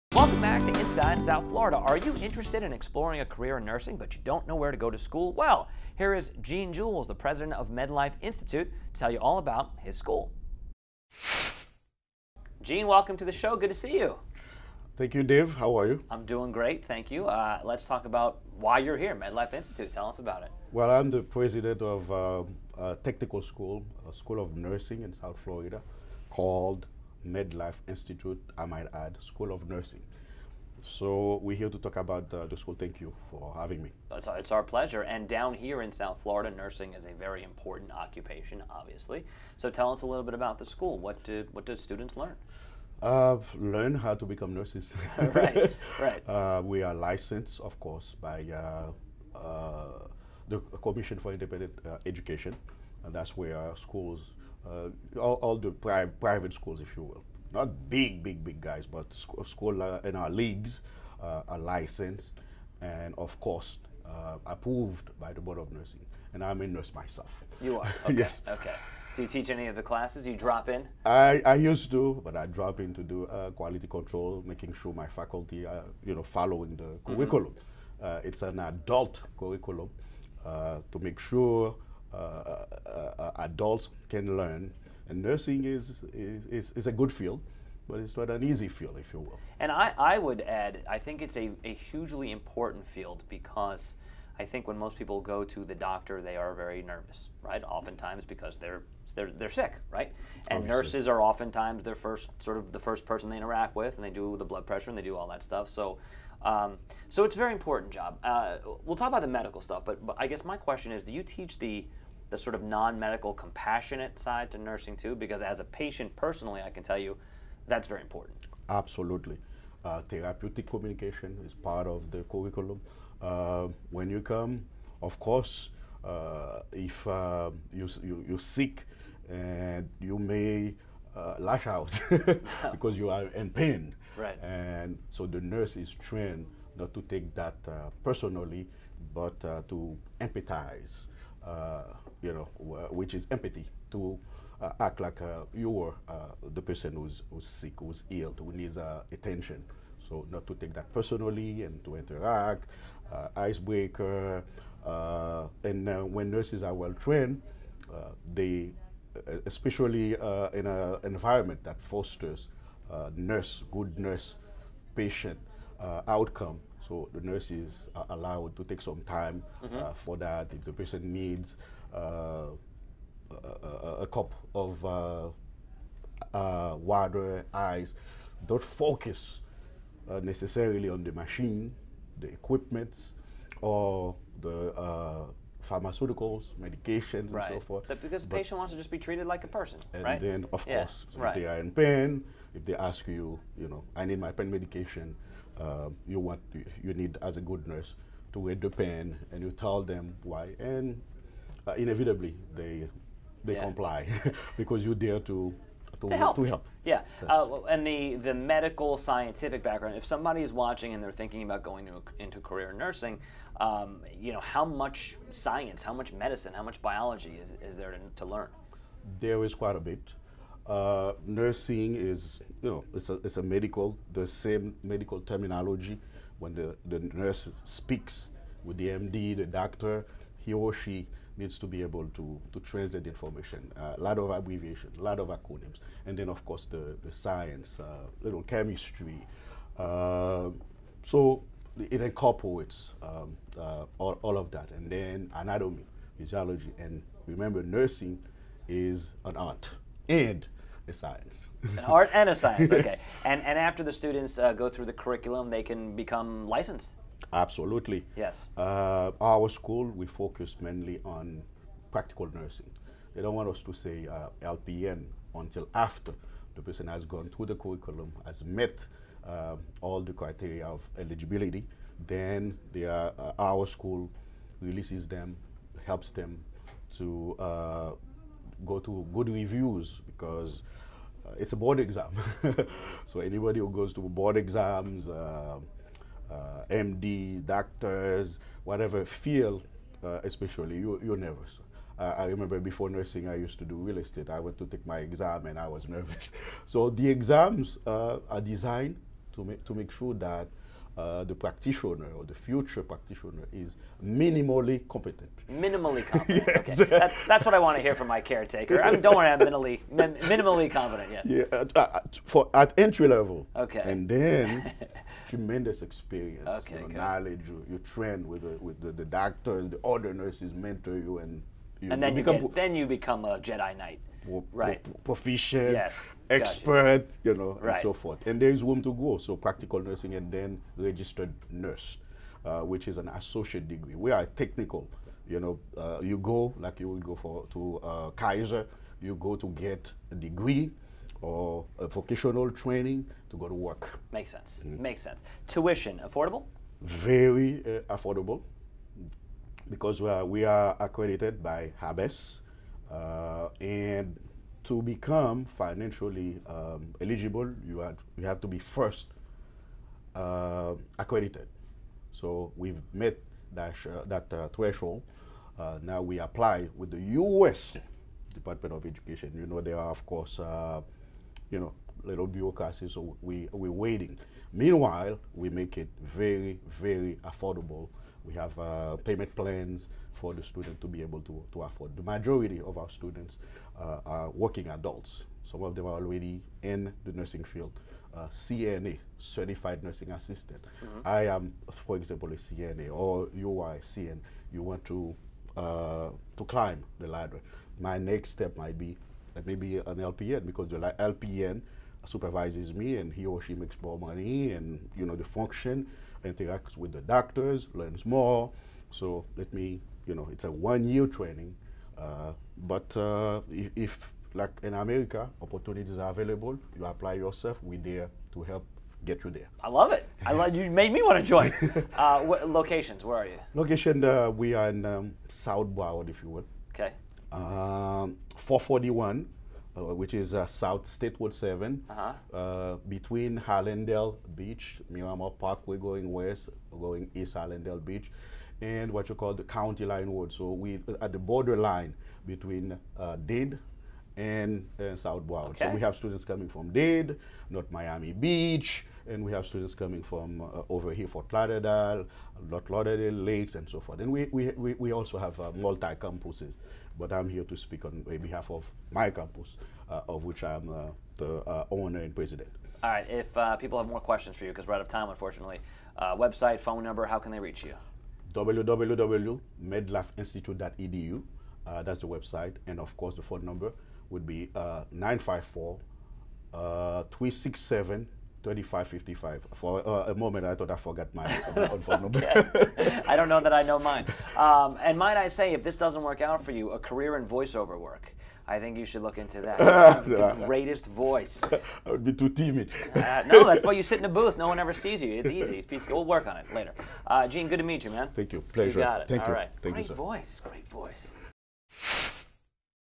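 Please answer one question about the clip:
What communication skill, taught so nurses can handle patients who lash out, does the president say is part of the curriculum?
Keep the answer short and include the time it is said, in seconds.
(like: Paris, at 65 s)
Therapeutic communication, at 120 s.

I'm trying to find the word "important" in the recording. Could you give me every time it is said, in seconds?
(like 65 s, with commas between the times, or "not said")
37 s, 92 s, 107 s, 118 s.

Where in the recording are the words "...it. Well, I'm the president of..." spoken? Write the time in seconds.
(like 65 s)
20 s.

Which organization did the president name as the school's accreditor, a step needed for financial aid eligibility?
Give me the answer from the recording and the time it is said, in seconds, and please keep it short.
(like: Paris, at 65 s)
HABES, at 351 s.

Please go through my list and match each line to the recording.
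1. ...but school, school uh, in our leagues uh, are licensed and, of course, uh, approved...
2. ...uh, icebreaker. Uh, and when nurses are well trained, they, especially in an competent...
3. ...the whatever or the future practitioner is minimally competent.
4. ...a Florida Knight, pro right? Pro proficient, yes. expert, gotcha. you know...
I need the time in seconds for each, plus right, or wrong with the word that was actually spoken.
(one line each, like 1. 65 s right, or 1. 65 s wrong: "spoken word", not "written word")
1. 58 s right
2. 153 s wrong: "environment", not "competent"
3. 301 s wrong: "practitioner", not "whatever"
4. 323 s wrong: "Jedi", not "Florida".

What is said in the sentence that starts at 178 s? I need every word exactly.
Don't focus uh, necessarily on the machine, the equipment, or the uh, pharmaceuticals, medications, right.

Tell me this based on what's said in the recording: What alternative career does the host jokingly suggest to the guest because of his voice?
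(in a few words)
Voiceover work.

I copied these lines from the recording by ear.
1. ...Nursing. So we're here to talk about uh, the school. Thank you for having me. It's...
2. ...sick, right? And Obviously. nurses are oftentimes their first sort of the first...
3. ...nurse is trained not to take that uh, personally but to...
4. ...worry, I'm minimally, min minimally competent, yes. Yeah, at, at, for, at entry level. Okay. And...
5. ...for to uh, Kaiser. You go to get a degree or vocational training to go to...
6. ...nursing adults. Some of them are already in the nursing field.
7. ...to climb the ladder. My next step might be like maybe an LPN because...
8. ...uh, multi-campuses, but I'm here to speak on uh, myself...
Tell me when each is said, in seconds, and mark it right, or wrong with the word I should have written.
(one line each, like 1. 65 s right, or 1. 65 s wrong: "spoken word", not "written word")
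1. 29 s right
2. 99 s right
3. 135 s right
4. 309 s right
5. 337 s right
6. 384 s wrong: "working", not "nursing"
7. 396 s right
8. 455 s wrong: "behalf", not "myself".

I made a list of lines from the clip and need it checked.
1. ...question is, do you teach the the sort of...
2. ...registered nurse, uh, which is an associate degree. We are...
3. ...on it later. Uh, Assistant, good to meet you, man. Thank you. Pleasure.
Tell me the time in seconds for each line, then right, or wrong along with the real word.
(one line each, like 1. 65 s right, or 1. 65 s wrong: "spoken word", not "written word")
1. 110 s right
2. 330 s right
3. 496 s wrong: "Jean", not "Assistant".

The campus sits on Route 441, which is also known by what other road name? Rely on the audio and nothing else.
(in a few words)
South State Road 7.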